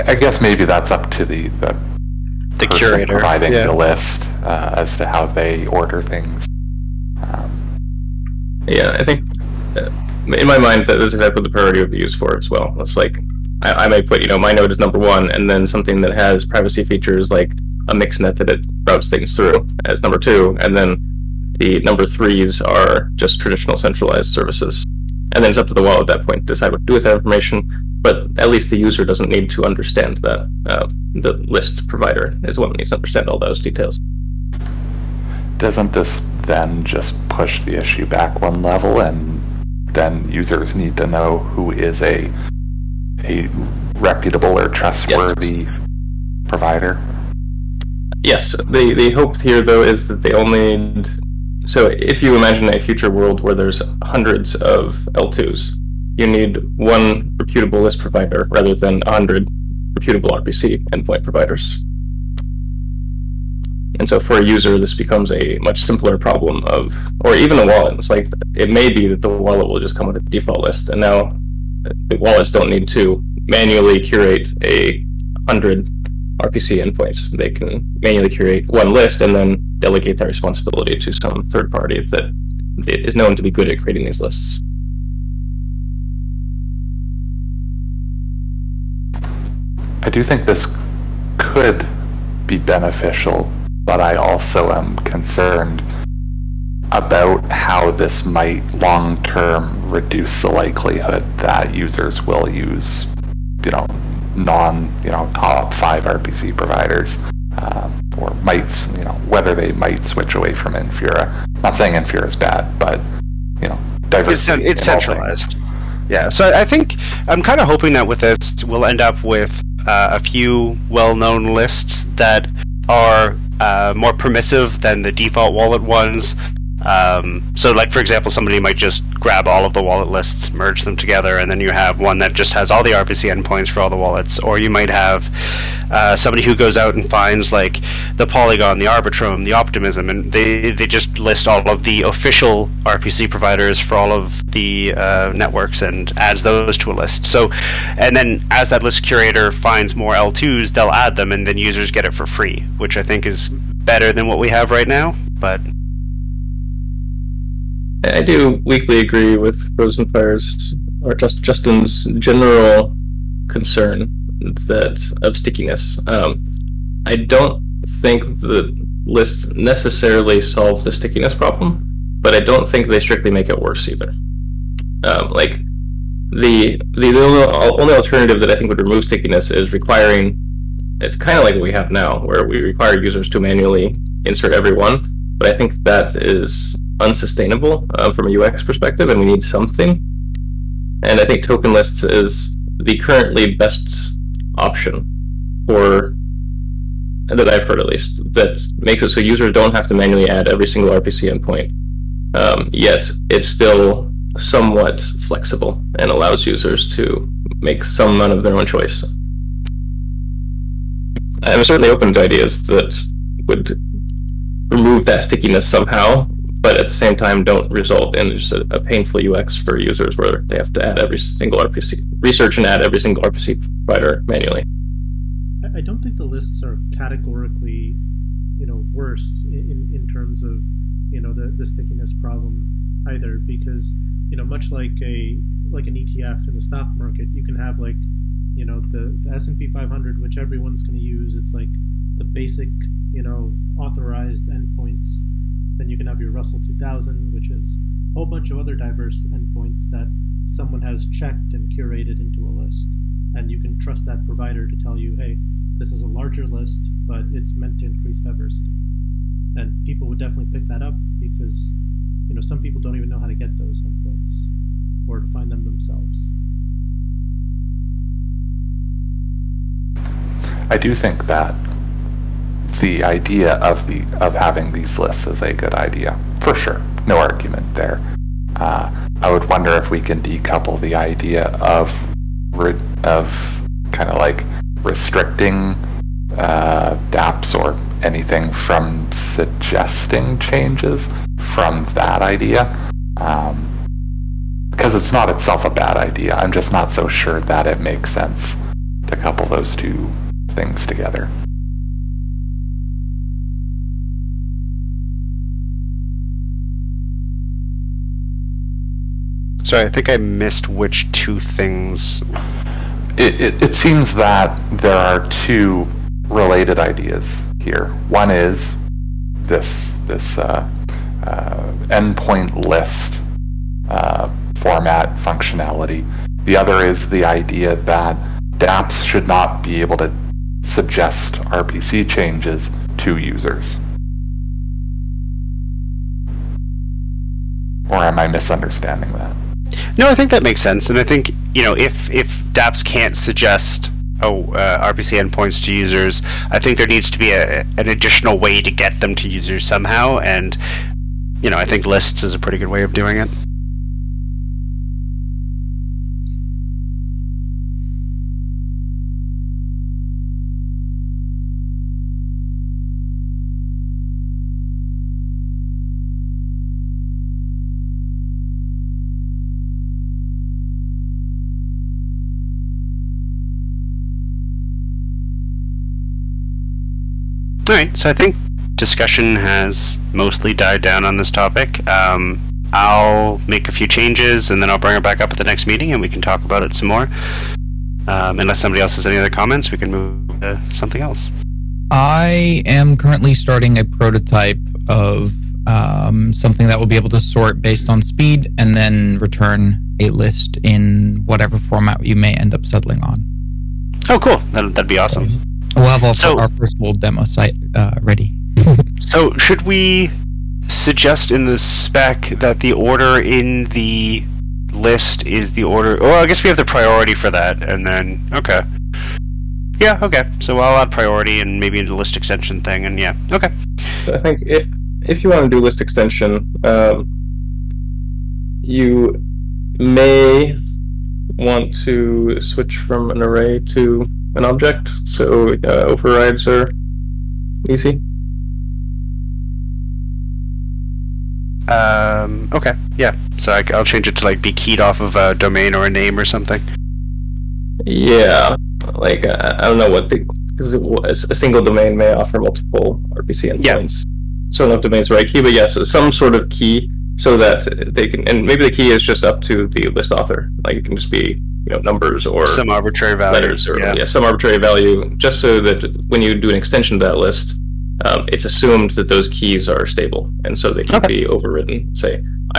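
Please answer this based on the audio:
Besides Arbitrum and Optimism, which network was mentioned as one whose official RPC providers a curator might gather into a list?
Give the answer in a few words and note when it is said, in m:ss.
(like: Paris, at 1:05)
Polygon, at 2:18.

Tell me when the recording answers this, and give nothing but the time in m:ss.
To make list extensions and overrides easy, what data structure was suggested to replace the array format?
7:14.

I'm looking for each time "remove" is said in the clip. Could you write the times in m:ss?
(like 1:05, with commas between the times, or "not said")
2:58, 3:34.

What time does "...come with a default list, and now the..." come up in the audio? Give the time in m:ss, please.
1:09.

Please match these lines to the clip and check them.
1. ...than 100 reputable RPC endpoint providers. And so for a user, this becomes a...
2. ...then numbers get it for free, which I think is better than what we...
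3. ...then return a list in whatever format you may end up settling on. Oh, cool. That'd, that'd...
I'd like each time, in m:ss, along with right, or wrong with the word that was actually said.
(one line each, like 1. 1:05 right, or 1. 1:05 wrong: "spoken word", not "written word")
1. 0:58 right
2. 2:31 wrong: "users", not "numbers"
3. 6:38 right.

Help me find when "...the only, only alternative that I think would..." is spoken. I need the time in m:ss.
2:56.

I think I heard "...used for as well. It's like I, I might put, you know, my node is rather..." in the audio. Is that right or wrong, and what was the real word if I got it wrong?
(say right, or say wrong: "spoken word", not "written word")
wrong: "number", not "rather".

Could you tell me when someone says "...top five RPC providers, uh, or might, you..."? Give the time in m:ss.
1:45.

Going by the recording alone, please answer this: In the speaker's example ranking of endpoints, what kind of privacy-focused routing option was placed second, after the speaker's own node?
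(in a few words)
mixnet.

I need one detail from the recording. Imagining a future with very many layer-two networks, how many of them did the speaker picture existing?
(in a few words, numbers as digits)
hundreds.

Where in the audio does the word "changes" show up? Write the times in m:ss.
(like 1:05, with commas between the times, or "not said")
4:50, 5:32, 6:23, 7:23.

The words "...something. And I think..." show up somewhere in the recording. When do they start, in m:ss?
3:09.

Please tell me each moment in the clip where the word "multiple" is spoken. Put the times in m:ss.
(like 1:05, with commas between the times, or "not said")
7:32.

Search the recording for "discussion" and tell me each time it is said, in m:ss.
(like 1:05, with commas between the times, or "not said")
6:18.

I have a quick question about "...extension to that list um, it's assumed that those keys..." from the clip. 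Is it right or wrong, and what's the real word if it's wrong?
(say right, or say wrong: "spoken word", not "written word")
right.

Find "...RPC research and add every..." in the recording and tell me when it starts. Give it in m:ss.
3:41.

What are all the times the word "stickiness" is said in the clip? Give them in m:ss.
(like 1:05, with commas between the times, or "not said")
2:45, 2:50, 2:59, 3:35, 3:51.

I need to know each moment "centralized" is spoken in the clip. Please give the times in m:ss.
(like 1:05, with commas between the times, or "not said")
0:23, 1:54.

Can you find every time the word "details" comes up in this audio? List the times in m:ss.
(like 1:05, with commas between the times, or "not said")
0:33.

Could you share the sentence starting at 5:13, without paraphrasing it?
It, it, it, seems that there are two related ideas here.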